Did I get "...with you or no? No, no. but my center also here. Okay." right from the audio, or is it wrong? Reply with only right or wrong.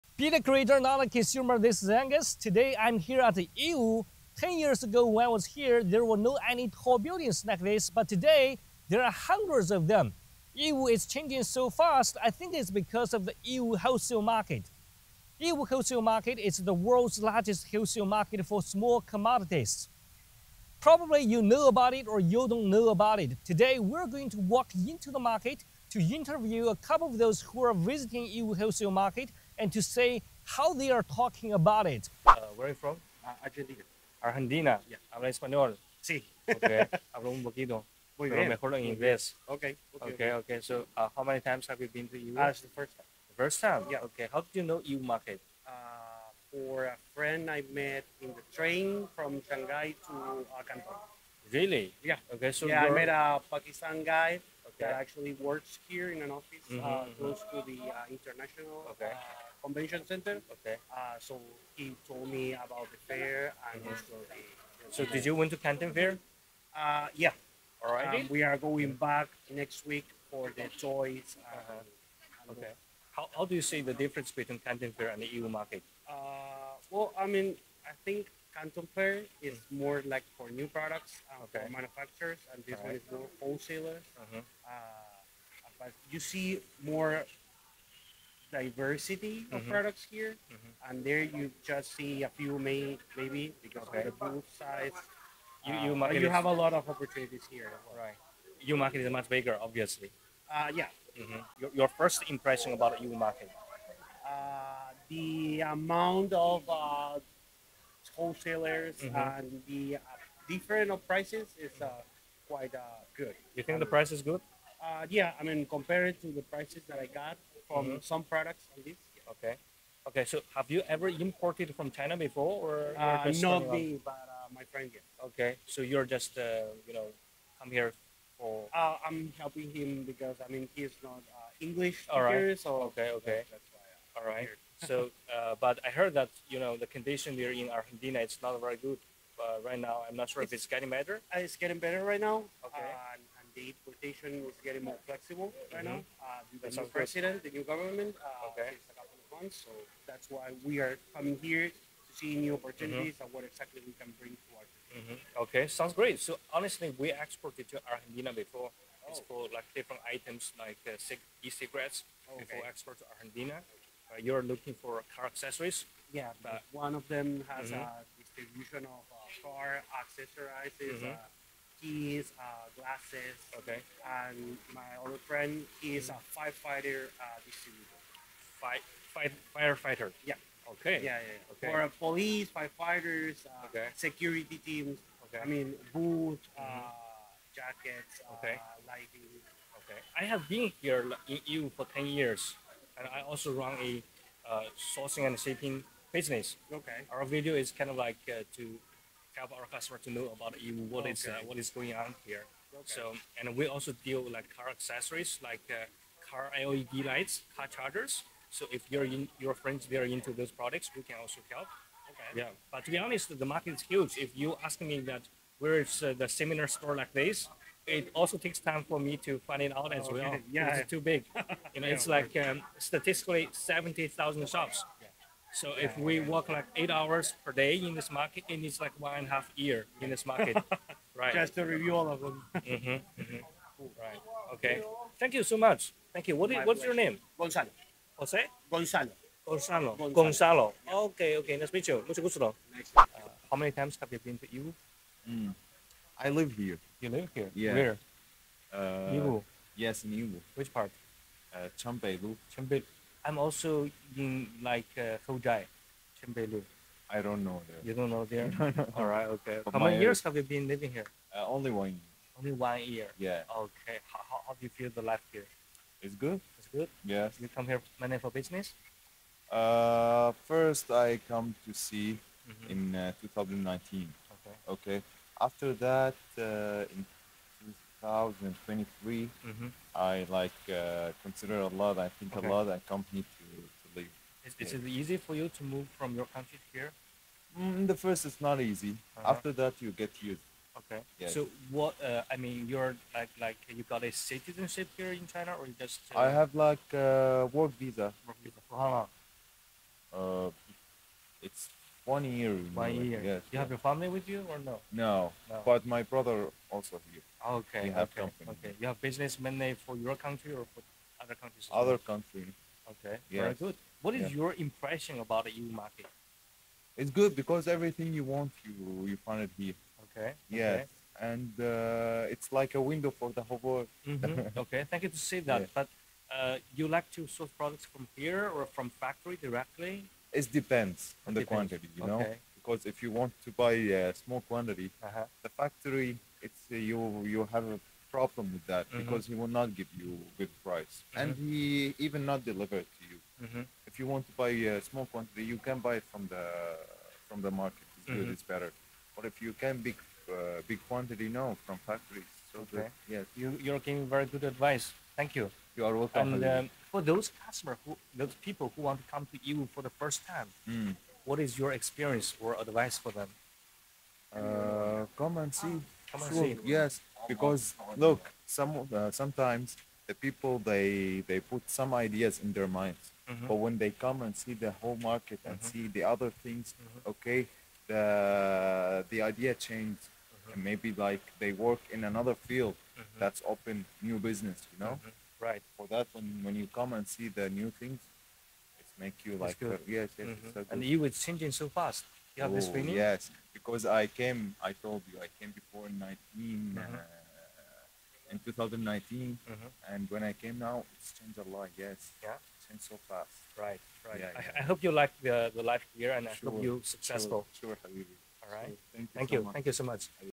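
wrong.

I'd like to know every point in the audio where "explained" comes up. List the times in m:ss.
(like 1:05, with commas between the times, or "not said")
not said.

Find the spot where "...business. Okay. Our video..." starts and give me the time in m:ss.
3:16.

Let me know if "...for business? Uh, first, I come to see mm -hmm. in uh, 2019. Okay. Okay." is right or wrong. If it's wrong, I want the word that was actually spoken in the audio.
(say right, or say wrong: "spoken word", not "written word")
right.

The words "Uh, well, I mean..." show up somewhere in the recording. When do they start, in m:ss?
1:16.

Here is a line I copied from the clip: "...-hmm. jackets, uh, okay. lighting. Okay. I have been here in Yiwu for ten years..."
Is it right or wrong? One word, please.
right.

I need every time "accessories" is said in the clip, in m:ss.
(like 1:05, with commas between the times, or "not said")
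2:45, 2:50, 3:24.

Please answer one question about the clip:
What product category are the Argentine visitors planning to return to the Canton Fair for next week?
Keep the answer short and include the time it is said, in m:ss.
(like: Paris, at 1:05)
toys, at 1:10.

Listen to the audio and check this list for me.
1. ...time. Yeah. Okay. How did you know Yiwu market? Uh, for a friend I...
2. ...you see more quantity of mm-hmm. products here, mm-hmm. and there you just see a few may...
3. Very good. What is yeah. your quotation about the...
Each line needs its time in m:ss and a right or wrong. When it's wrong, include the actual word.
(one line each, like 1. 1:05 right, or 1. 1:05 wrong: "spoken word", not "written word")
1. 0:43 right
2. 1:26 wrong: "diversity", not "quantity"
3. 5:13 wrong: "impression", not "quotation".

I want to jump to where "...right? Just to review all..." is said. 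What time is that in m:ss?
3:51.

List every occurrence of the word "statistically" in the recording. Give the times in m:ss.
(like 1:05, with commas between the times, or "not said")
3:42.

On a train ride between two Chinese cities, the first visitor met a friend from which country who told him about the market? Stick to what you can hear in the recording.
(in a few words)
Pakistan.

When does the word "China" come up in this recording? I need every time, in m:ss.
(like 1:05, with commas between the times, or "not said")
2:01, 4:55.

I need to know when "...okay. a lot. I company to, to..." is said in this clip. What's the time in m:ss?
4:42.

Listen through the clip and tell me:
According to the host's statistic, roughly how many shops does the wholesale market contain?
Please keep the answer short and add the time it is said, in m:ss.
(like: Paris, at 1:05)
70,000, at 3:43.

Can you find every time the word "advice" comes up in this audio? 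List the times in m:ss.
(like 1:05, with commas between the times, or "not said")
5:54, 6:02.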